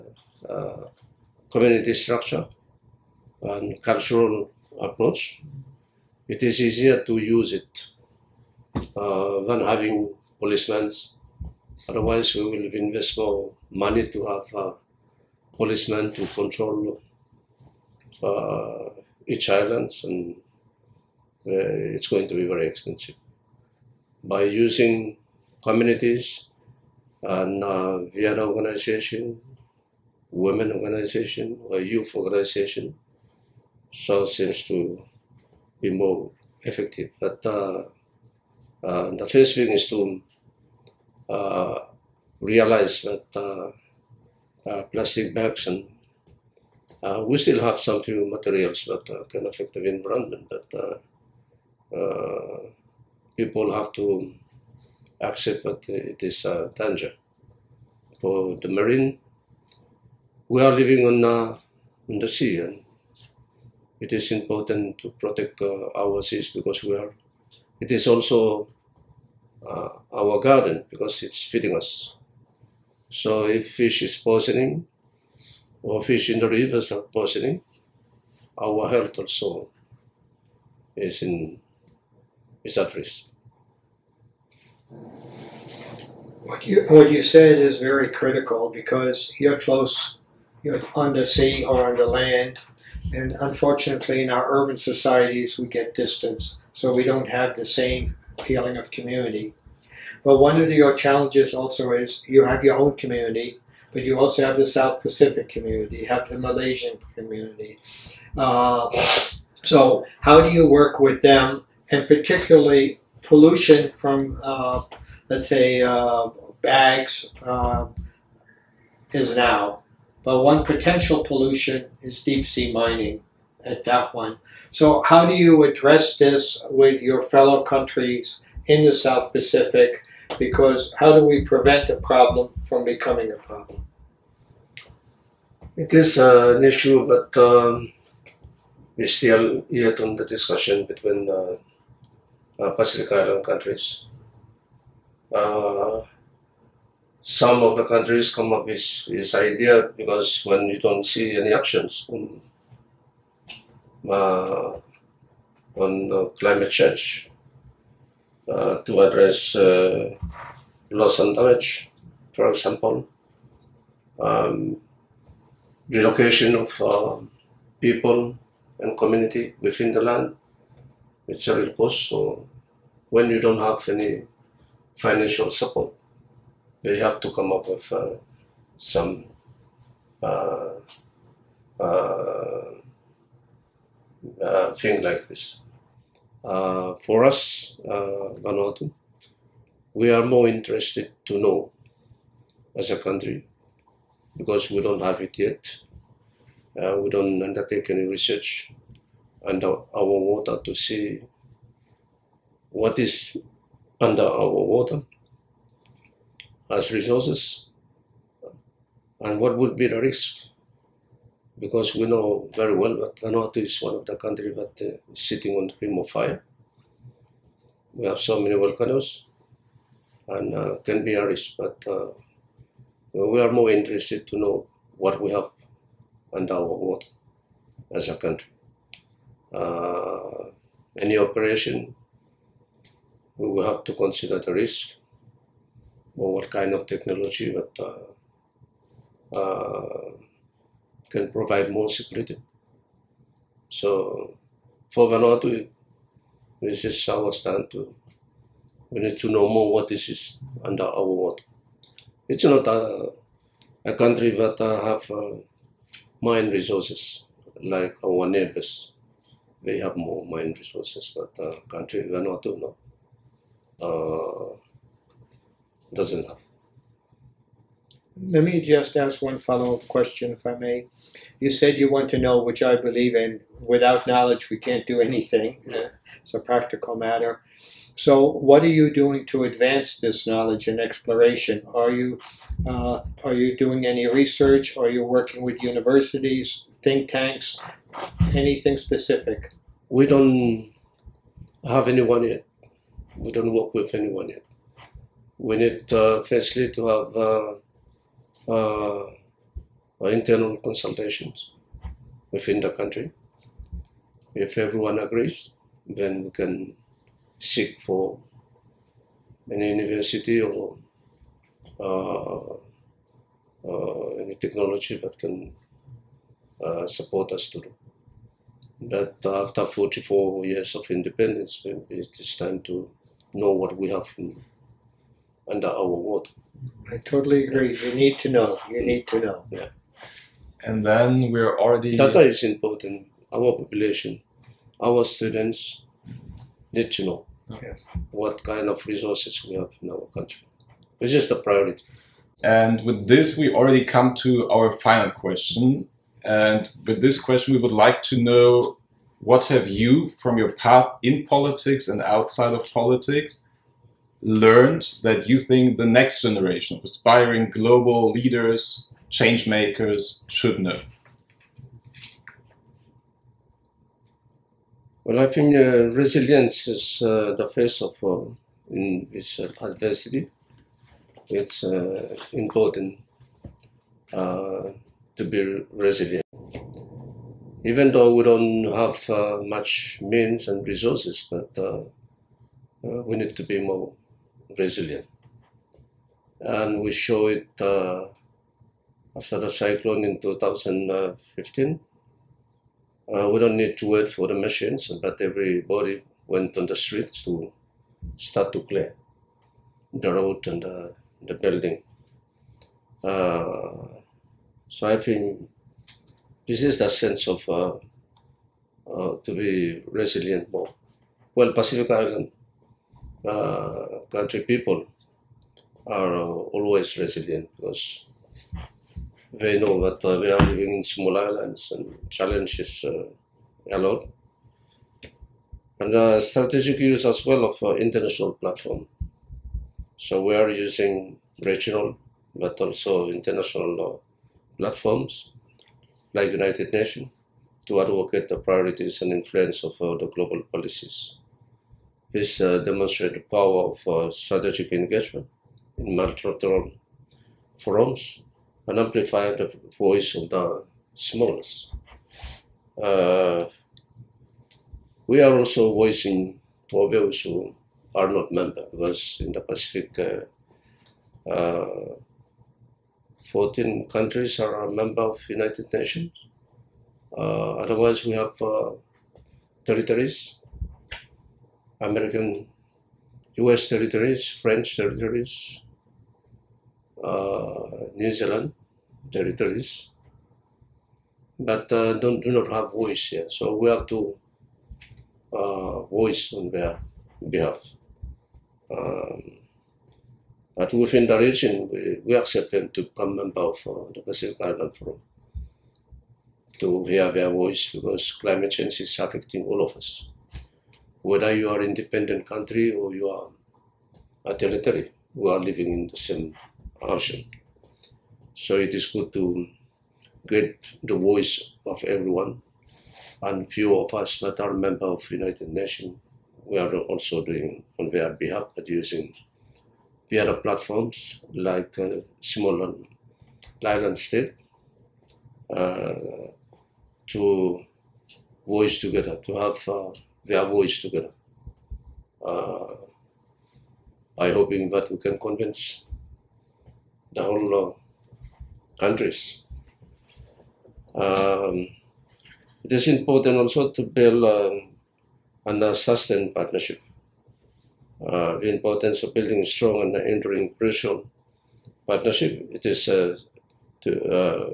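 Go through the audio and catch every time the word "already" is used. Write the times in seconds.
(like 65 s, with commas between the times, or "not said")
331 s, 343 s.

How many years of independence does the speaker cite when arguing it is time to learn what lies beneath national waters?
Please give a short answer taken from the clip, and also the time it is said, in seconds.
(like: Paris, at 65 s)
44, at 319 s.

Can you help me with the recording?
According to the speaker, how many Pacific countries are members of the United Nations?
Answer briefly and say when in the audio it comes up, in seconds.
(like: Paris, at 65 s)
14, at 463 s.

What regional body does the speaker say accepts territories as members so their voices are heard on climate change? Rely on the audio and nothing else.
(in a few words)
Pacific Island Forum.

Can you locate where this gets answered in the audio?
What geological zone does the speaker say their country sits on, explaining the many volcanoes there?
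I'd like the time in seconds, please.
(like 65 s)
215 s.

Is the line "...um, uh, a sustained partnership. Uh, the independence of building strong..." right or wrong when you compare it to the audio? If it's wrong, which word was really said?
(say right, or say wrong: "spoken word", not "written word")
wrong: "importance", not "independence".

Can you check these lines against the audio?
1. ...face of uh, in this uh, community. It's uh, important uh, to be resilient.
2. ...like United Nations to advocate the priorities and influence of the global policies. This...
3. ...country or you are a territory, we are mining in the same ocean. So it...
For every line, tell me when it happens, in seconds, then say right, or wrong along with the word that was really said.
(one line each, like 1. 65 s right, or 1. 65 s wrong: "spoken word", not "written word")
1. 367 s wrong: "adversity", not "community"
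2. 436 s right
3. 502 s wrong: "living", not "mining".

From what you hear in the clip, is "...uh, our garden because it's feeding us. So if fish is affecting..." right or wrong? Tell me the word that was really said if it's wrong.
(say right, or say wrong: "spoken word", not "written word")
wrong: "poisoning", not "affecting".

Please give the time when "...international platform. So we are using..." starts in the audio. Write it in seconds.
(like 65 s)
427 s.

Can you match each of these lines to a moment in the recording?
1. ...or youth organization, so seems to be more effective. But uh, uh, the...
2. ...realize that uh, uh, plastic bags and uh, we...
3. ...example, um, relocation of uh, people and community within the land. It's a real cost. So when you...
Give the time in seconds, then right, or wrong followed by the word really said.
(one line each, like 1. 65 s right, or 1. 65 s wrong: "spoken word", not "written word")
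1. 31 s right
2. 42 s right
3. 162 s right.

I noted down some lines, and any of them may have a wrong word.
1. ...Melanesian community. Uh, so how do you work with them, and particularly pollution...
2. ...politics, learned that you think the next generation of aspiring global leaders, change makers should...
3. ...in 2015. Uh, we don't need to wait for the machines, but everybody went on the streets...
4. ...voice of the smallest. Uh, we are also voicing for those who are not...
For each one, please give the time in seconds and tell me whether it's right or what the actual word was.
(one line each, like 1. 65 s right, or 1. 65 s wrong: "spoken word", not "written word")
1. 106 s right
2. 352 s right
3. 390 s right
4. 449 s right.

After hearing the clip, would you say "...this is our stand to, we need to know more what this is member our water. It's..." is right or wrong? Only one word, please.
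wrong.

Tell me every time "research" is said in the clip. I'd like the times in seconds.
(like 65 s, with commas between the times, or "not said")
198 s, 284 s.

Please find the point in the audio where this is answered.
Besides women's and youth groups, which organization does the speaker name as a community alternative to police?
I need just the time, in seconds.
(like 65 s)
28 s.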